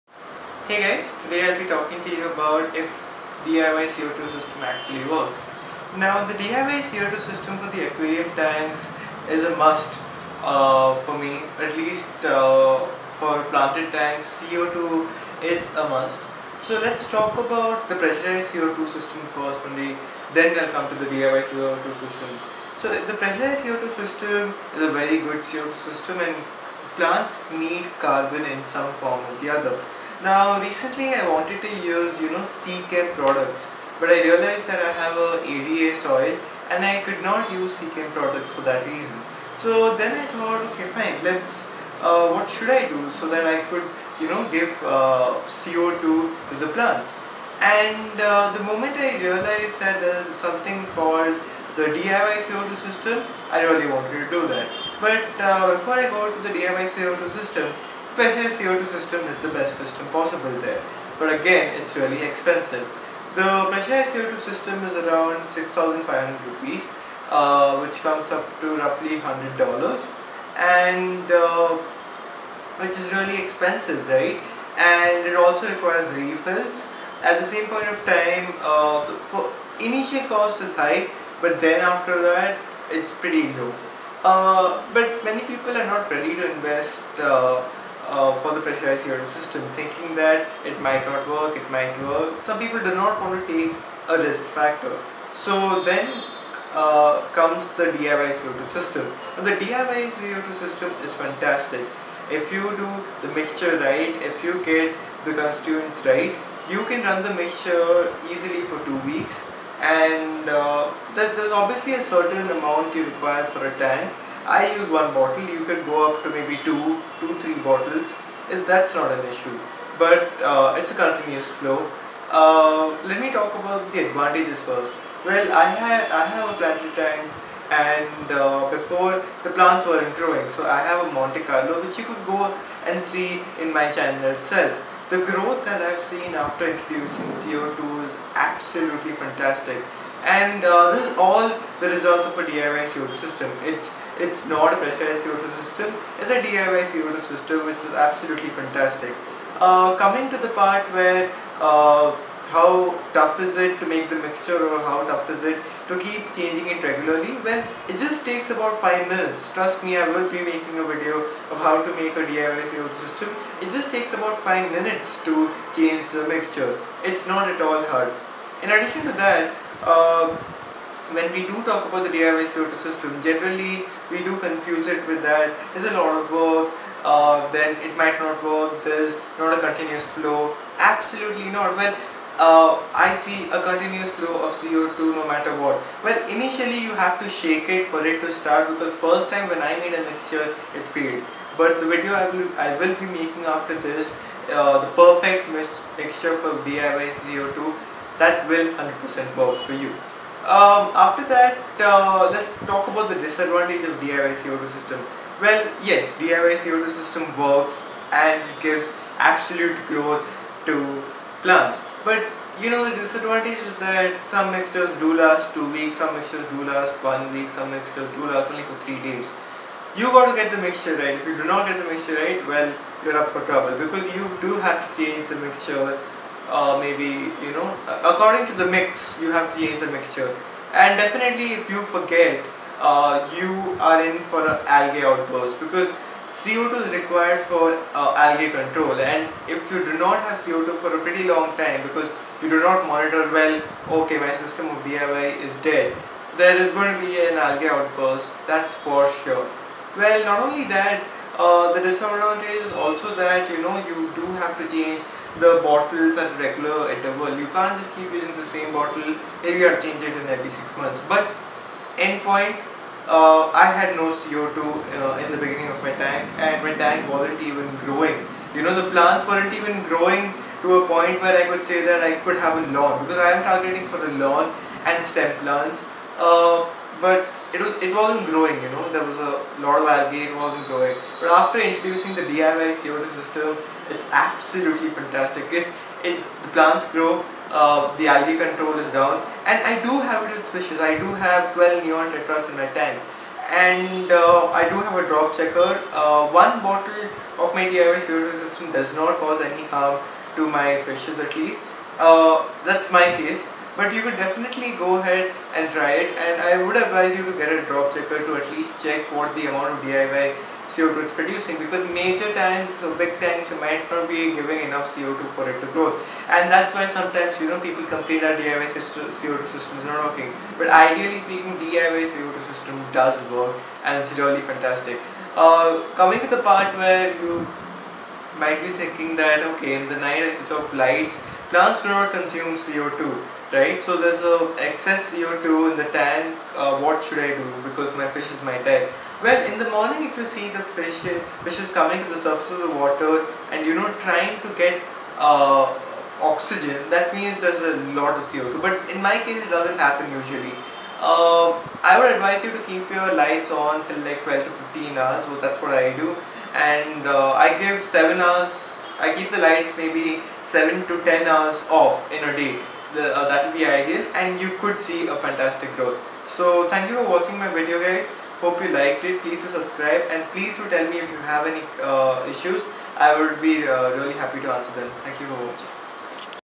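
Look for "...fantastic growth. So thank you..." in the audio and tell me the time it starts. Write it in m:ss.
6:05.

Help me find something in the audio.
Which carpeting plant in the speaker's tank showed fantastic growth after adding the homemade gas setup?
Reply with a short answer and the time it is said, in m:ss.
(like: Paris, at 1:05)
Monte Carlo, at 2:11.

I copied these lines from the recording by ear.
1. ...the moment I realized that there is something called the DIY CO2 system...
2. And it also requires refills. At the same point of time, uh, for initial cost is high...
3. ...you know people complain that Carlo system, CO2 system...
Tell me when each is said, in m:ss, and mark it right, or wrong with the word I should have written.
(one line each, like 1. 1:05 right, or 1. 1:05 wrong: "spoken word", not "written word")
1. 0:48 right
2. 1:14 right
3. 5:17 wrong: "DIY", not "Carlo".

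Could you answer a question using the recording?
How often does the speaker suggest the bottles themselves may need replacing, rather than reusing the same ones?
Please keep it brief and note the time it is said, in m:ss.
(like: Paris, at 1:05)
Every six months, at 4:20.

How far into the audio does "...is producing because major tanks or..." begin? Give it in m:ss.
5:11.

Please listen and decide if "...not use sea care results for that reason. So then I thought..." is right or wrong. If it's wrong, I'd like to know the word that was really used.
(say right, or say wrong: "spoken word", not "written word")
wrong: "products", not "results".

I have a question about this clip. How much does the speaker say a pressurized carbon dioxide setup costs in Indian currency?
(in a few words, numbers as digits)
6,500 rupees.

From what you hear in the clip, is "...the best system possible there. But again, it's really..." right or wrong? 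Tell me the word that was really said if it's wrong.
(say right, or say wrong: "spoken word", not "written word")
right.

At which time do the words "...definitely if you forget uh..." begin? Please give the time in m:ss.
3:50.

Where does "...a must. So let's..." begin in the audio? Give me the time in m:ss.
0:15.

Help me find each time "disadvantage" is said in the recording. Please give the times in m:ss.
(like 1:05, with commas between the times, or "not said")
3:23, 3:32, 4:11.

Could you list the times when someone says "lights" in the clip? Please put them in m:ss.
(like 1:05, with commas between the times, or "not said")
5:30, 5:53, 5:59.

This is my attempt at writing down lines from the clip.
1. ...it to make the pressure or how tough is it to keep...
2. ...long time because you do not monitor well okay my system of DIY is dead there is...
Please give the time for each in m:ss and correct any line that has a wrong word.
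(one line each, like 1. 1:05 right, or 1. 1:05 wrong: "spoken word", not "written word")
1. 2:33 wrong: "mixture", not "pressure"
2. 4:01 right.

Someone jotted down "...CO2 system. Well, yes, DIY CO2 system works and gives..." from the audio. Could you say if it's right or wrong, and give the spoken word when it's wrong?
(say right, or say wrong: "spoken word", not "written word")
right.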